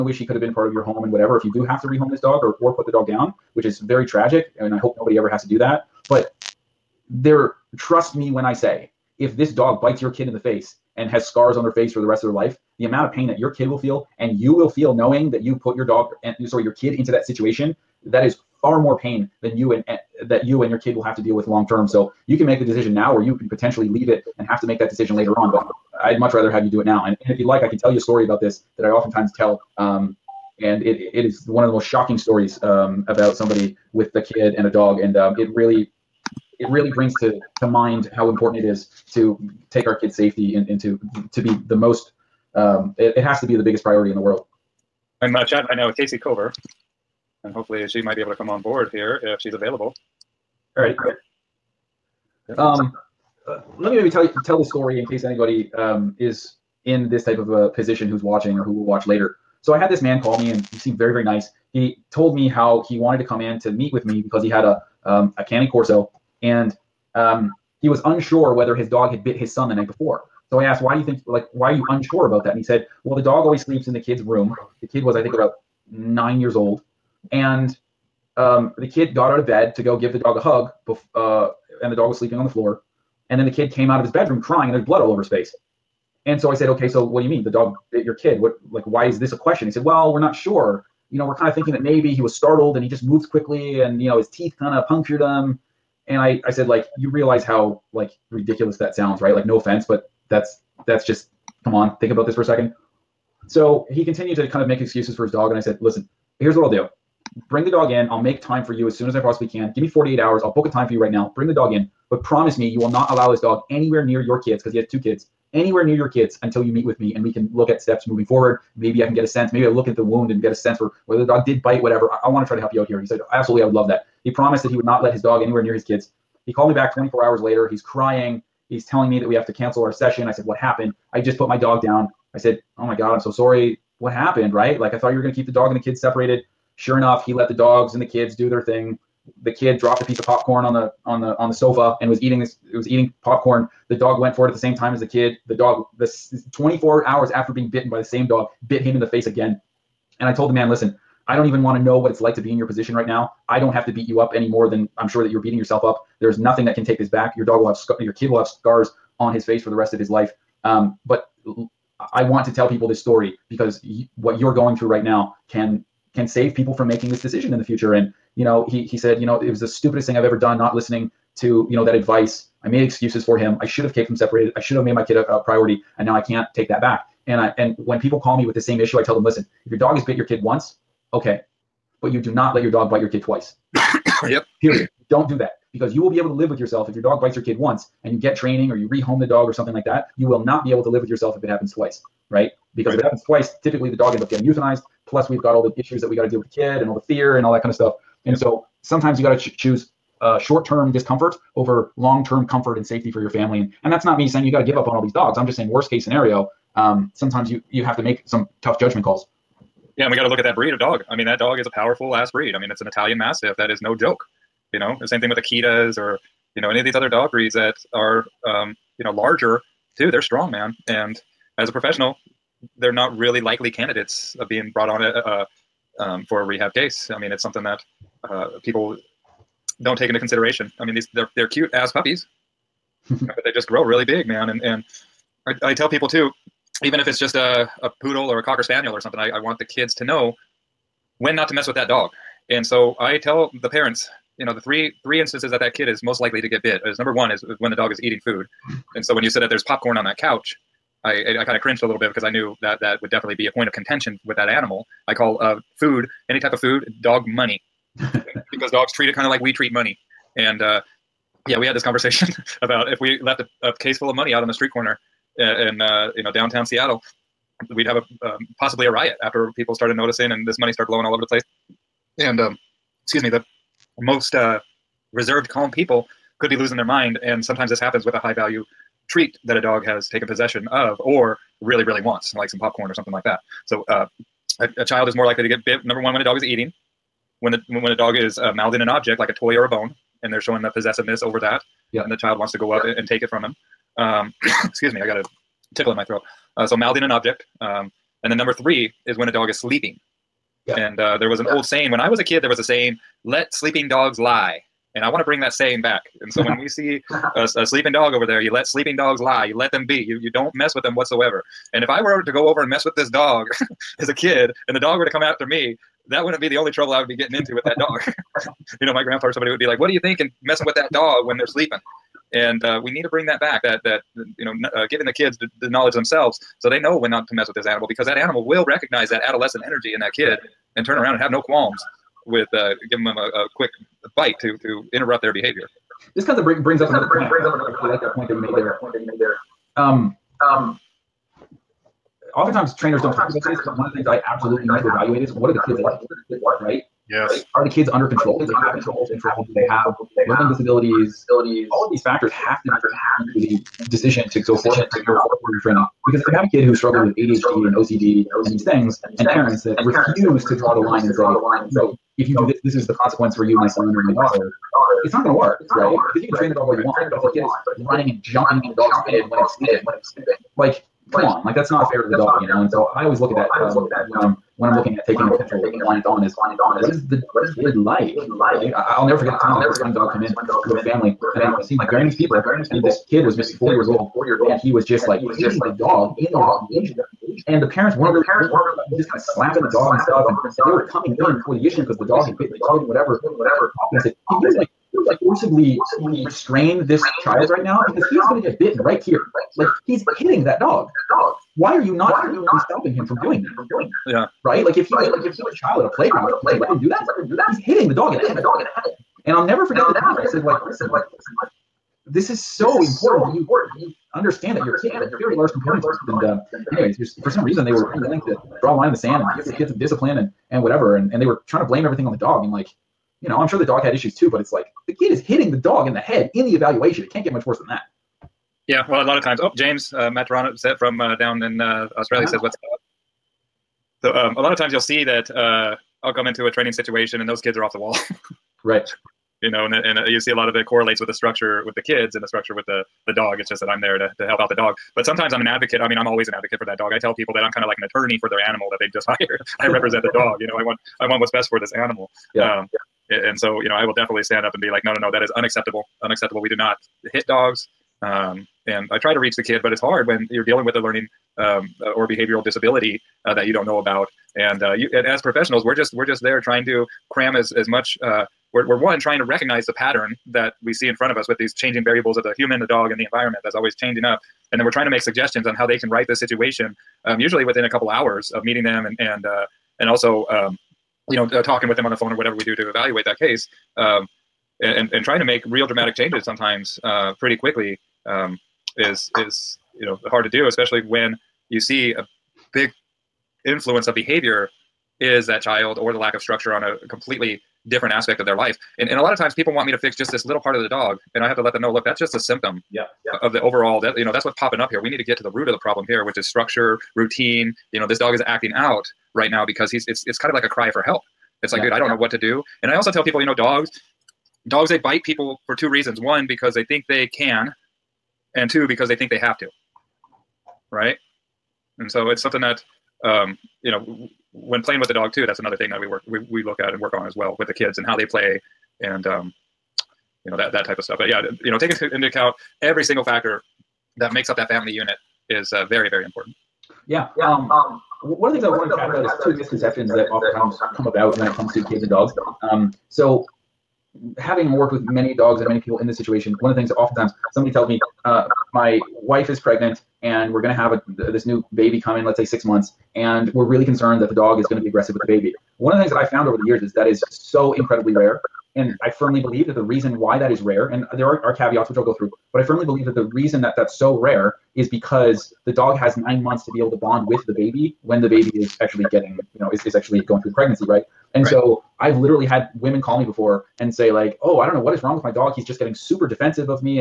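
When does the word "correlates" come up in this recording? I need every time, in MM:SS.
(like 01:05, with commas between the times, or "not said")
07:20.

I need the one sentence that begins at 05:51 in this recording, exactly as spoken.
All of these factors have to be the decision to go forward, to go forward from.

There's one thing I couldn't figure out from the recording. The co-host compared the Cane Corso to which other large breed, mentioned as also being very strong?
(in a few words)
Akitas.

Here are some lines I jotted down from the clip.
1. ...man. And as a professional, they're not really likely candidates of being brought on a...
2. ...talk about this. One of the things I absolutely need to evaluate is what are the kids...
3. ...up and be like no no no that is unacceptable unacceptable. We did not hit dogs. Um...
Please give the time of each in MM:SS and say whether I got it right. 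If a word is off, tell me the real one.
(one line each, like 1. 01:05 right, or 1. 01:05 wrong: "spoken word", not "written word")
1. 03:40 right
2. 05:43 right
3. 07:34 right.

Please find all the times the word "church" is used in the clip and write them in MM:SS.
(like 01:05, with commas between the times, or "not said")
not said.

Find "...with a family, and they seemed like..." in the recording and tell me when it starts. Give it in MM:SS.
06:20.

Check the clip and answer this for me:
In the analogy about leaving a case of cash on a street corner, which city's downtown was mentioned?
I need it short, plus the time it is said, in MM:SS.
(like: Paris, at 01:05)
Seattle, at 04:26.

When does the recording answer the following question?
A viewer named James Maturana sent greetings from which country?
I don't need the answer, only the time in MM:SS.
07:11.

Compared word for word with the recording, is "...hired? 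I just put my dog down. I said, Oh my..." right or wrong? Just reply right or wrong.
wrong.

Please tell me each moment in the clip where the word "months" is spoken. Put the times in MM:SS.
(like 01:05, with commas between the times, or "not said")
09:12, 09:26.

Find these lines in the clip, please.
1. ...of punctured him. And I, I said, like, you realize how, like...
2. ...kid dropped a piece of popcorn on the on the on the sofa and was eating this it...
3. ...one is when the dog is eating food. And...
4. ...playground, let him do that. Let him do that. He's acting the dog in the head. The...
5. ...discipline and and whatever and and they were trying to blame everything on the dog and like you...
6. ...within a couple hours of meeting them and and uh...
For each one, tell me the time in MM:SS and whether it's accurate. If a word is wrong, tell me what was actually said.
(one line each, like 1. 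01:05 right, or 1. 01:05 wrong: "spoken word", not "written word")
1. 01:34 right
2. 02:19 right
3. 04:07 right
4. 06:45 wrong: "hitting", not "acting"
5. 06:59 right
6. 07:57 right.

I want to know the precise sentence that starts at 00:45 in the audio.
I'm uh, chatting right now with Casey Cover, and hopefully she might be able to come on board here if she's available.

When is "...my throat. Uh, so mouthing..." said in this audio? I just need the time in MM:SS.
04:55.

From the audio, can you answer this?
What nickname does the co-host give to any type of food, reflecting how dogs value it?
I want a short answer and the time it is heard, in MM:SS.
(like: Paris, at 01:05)
Dog money, at 04:17.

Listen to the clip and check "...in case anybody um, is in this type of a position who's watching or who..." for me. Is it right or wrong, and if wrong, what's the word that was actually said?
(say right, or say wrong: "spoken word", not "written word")
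right.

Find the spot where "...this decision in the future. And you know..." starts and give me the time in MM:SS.
02:47.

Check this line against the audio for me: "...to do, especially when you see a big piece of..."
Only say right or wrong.
wrong.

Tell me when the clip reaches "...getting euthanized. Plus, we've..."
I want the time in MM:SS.
03:14.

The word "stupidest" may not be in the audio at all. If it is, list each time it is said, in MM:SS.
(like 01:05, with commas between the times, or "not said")
02:49.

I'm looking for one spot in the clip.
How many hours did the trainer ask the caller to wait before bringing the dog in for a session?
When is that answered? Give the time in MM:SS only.
01:49.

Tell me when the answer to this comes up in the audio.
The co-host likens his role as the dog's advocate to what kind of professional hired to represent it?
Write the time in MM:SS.
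07:27.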